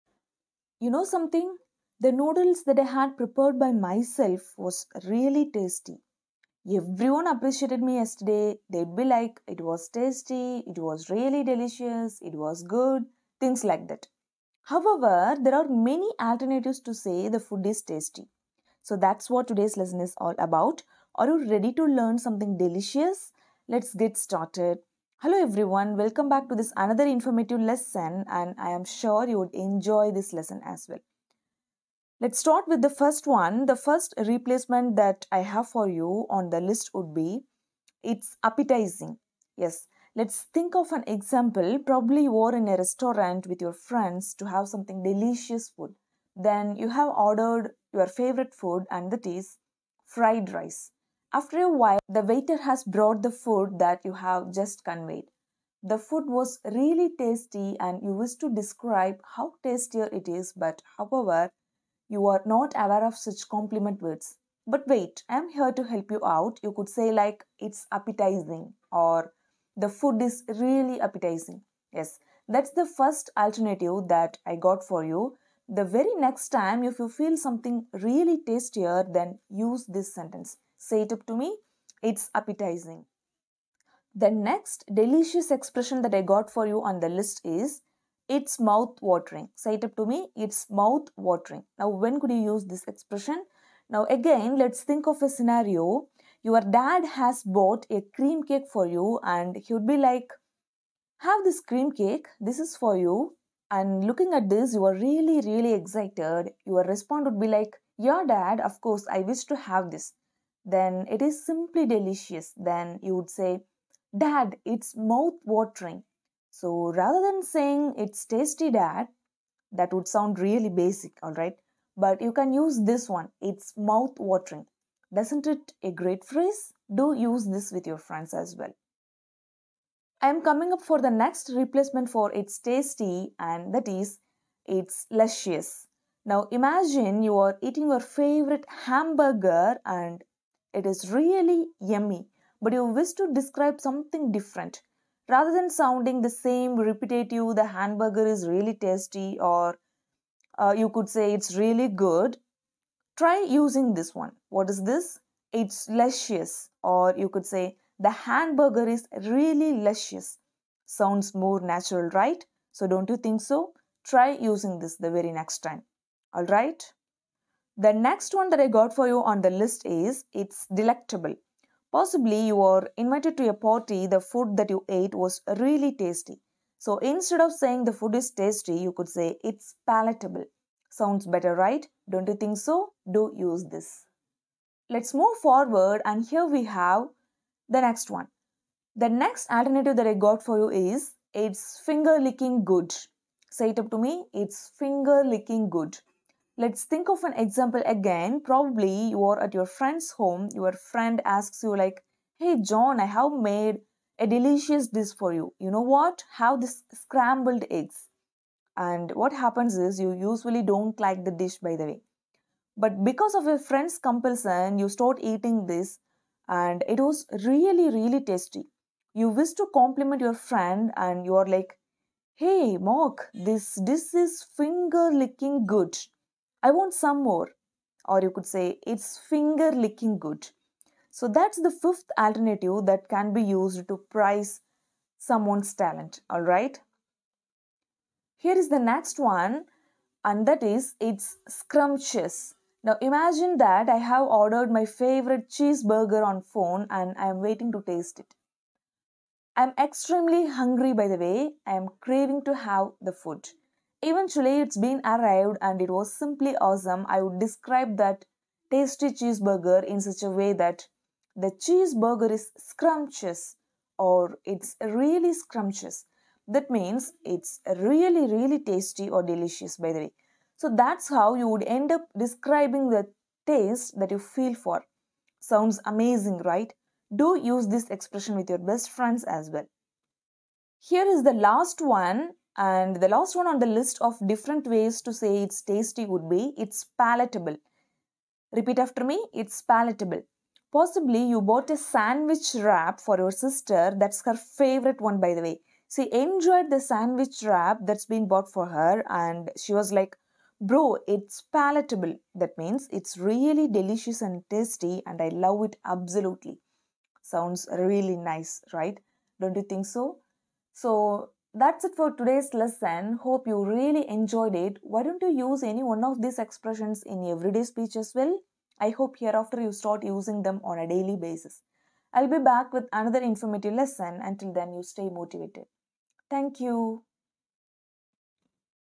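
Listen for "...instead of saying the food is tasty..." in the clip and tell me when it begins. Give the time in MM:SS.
02:56.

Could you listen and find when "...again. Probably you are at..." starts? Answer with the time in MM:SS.
03:17.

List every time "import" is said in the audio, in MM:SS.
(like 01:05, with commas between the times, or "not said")
not said.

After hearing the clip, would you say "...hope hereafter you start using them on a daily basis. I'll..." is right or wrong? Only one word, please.
right.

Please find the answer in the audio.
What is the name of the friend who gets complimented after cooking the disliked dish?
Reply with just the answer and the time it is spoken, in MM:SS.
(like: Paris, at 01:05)
Mark, at 03:42.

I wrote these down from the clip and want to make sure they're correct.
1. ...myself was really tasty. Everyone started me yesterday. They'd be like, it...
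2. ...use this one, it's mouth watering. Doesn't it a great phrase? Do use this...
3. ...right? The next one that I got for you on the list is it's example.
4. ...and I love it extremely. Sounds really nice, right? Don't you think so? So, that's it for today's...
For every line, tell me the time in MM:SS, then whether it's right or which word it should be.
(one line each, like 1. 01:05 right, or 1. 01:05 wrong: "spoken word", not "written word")
1. 00:03 wrong: "appreciated", not "started"
2. 02:02 right
3. 02:46 wrong: "delectable", not "example"
4. 05:05 wrong: "absolutely", not "extremely".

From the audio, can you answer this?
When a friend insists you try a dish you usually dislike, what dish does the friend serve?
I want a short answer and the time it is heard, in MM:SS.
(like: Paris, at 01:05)
scrambled eggs, at 03:26.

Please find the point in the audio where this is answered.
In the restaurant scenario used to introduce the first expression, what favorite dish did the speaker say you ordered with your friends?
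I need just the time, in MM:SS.
00:50.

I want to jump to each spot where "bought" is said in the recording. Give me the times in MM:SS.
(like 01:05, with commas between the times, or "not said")
01:37, 04:51, 04:58.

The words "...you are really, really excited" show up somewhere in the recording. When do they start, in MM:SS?
01:44.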